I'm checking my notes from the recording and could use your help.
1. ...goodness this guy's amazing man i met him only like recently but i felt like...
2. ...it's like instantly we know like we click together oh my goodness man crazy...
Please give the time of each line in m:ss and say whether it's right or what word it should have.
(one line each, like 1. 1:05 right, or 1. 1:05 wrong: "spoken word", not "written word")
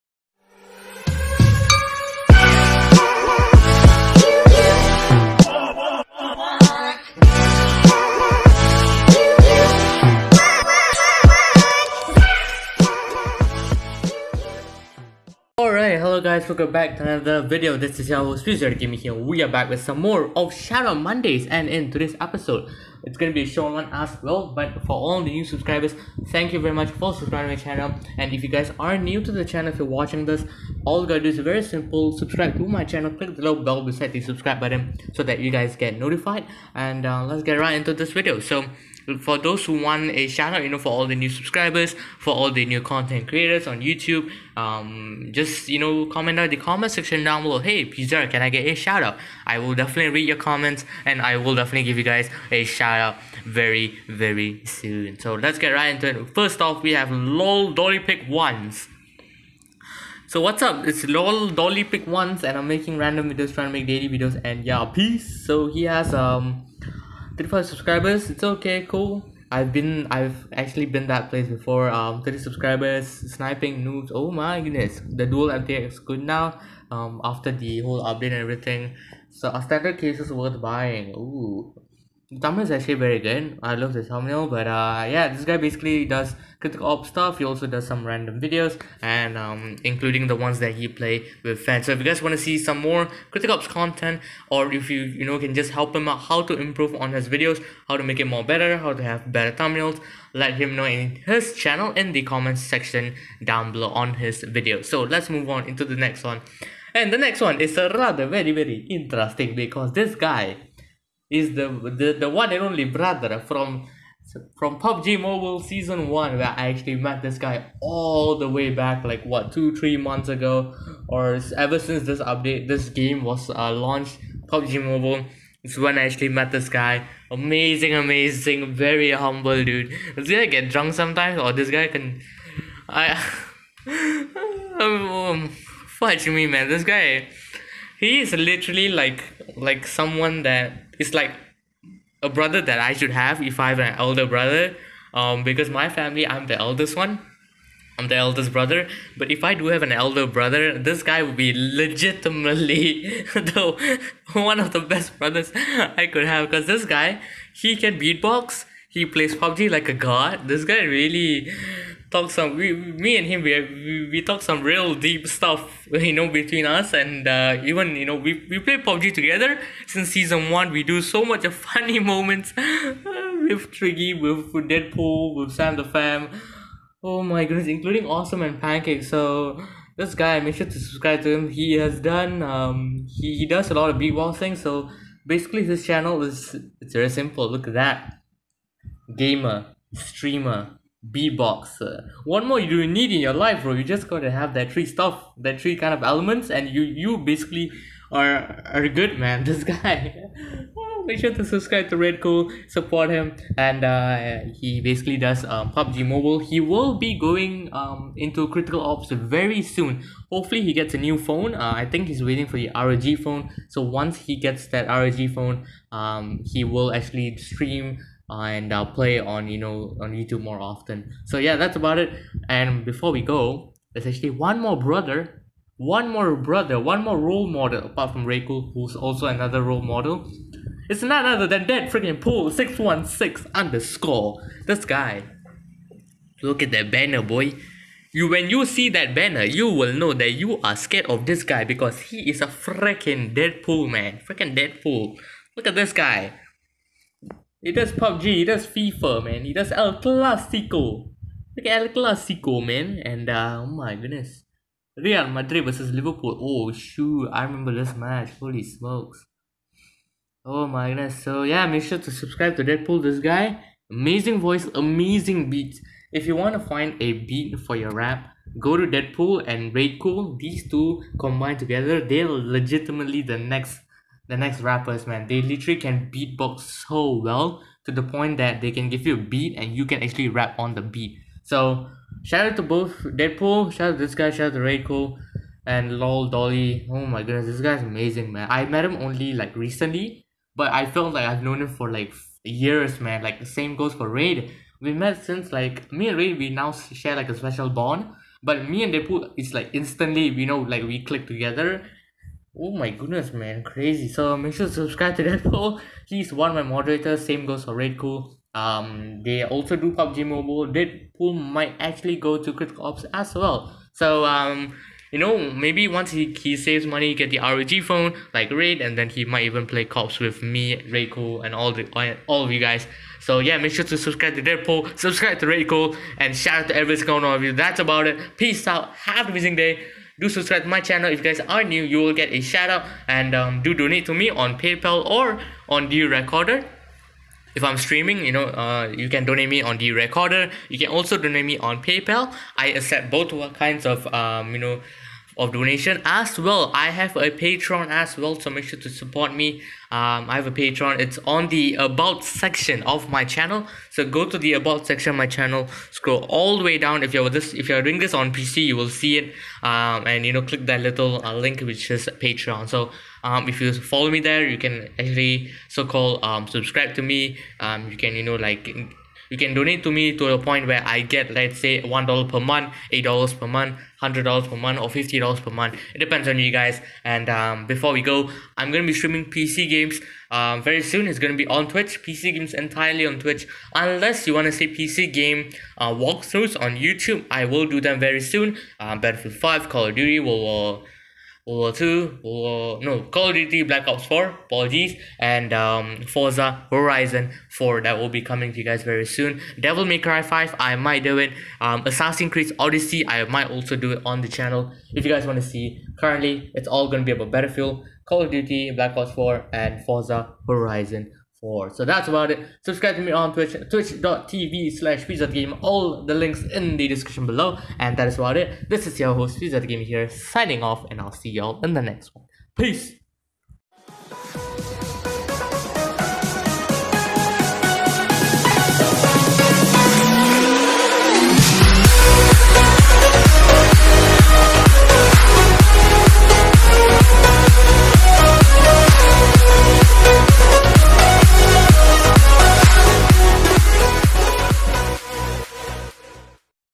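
1. 4:47 right
2. 4:59 right.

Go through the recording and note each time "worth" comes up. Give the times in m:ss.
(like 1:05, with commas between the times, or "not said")
1:20.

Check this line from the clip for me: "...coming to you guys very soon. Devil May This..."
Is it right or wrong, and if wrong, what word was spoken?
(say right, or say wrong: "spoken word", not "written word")
wrong: "Cry", not "This".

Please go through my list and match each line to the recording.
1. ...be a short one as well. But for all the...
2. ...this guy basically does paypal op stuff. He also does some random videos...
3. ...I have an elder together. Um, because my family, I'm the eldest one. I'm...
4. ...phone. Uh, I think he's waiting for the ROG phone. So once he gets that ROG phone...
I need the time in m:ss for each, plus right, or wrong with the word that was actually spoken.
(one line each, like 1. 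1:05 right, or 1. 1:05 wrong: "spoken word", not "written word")
1. 0:23 right
2. 1:25 wrong: "critical", not "paypal"
3. 2:23 wrong: "brother", not "together"
4. 3:31 right.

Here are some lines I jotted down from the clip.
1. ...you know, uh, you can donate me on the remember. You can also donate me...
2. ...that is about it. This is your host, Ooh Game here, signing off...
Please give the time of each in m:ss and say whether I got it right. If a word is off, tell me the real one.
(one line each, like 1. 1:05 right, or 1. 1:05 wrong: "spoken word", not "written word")
1. 5:38 wrong: "recorder", not "remember"
2. 6:57 wrong: "Pizza", not "Ooh".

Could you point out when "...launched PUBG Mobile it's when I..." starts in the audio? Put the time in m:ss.
2:03.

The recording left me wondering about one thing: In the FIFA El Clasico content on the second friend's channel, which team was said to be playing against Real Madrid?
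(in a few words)
Liverpool.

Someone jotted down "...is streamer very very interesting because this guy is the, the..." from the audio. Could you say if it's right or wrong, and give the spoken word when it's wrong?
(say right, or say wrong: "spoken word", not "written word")
wrong: "rather", not "streamer".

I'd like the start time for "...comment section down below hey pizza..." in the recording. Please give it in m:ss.
0:46.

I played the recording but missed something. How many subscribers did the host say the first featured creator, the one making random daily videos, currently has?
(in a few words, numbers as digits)
35.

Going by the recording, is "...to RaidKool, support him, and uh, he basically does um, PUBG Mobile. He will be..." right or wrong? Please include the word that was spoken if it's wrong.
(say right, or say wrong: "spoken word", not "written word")
right.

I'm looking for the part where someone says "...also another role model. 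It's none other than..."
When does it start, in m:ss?
3:48.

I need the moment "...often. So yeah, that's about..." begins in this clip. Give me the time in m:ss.
3:40.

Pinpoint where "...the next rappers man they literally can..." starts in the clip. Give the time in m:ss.
4:34.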